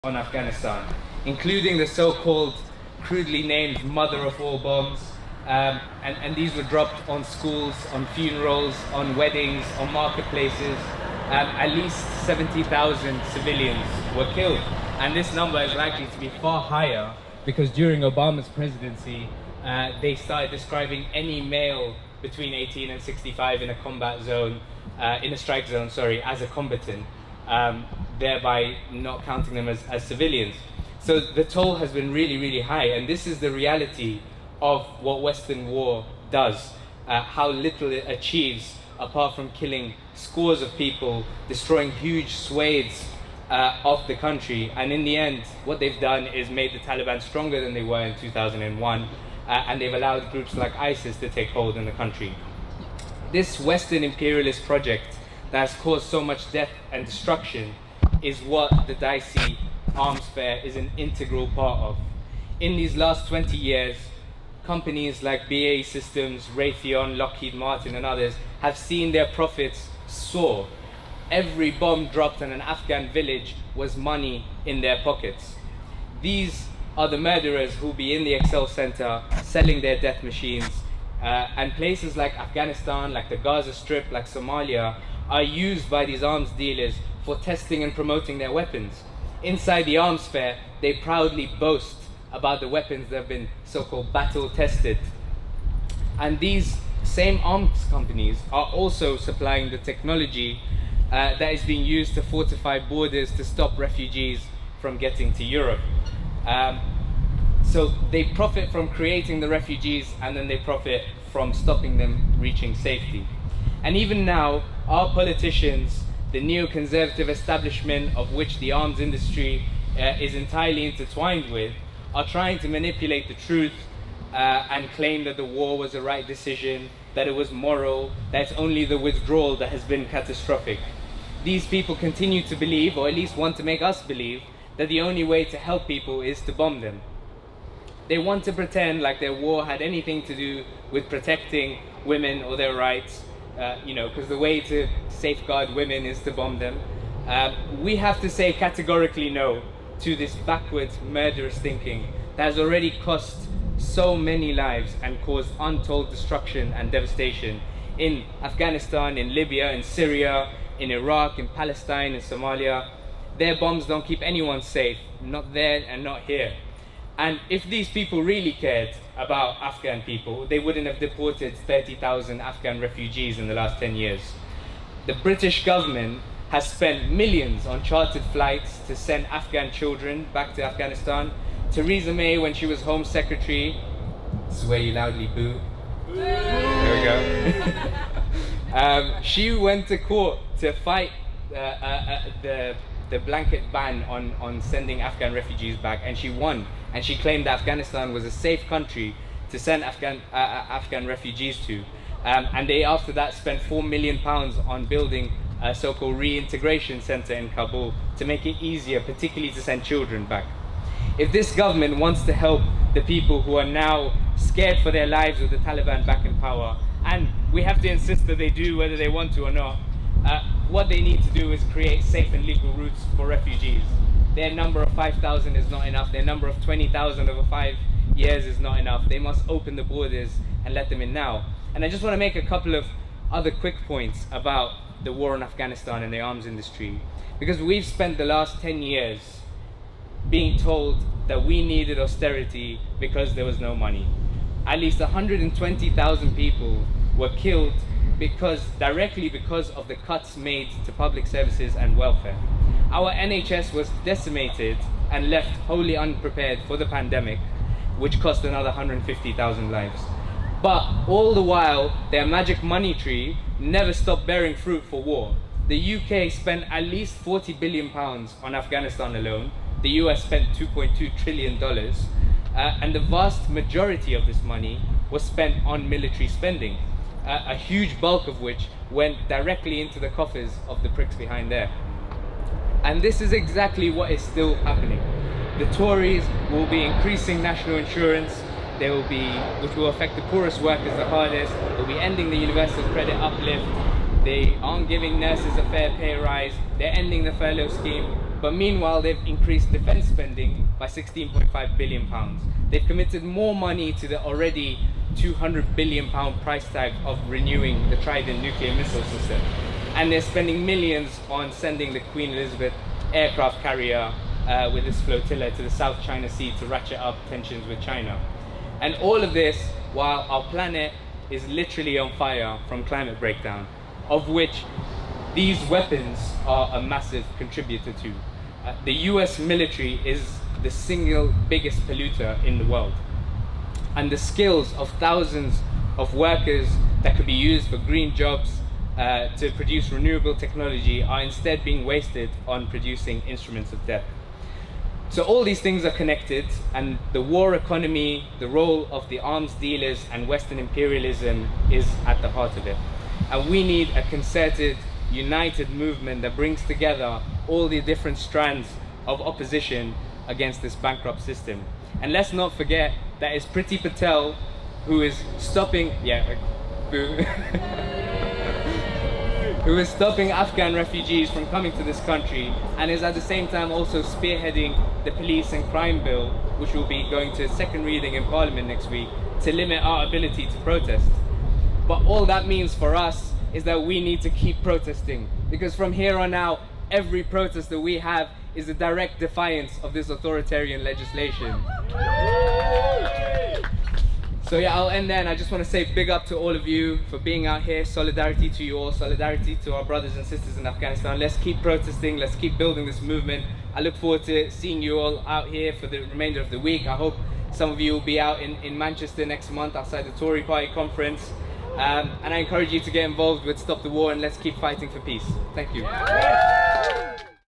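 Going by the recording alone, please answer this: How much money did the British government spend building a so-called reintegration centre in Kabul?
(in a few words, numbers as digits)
£4 million.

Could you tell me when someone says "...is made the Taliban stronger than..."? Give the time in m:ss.
0:46.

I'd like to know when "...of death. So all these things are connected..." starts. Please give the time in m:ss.
5:43.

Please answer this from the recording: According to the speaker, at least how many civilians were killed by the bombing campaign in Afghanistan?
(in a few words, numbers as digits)
70,000.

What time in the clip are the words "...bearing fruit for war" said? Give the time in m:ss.
4:24.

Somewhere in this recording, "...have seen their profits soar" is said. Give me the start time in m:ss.
1:08.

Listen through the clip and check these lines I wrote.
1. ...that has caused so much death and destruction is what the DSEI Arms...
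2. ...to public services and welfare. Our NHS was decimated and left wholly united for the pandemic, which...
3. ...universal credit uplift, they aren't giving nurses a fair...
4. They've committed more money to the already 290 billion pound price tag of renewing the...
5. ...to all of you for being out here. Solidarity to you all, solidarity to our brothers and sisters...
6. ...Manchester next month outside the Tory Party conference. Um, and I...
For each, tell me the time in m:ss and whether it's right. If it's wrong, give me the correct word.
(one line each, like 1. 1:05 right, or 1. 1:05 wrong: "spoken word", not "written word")
1. 0:55 right
2. 4:10 wrong: "unprepared", not "united"
3. 4:52 right
4. 5:02 wrong: "200", not "290"
5. 6:36 right
6. 6:48 right.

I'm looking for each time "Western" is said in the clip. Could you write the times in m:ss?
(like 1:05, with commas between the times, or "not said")
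0:35, 0:53, 5:50.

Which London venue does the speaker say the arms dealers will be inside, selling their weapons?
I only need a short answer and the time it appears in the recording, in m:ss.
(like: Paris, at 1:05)
ExCeL Center, at 1:18.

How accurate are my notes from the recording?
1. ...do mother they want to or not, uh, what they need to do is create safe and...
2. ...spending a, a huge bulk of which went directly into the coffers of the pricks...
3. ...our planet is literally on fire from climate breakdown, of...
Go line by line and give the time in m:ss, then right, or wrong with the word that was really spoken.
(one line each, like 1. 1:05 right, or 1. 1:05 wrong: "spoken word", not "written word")
1. 3:38 wrong: "whether", not "mother"
2. 4:36 right
3. 5:20 right.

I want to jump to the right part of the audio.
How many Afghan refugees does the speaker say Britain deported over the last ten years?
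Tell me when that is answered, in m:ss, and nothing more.
2:51.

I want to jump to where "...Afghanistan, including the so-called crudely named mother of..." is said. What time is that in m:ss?
0:00.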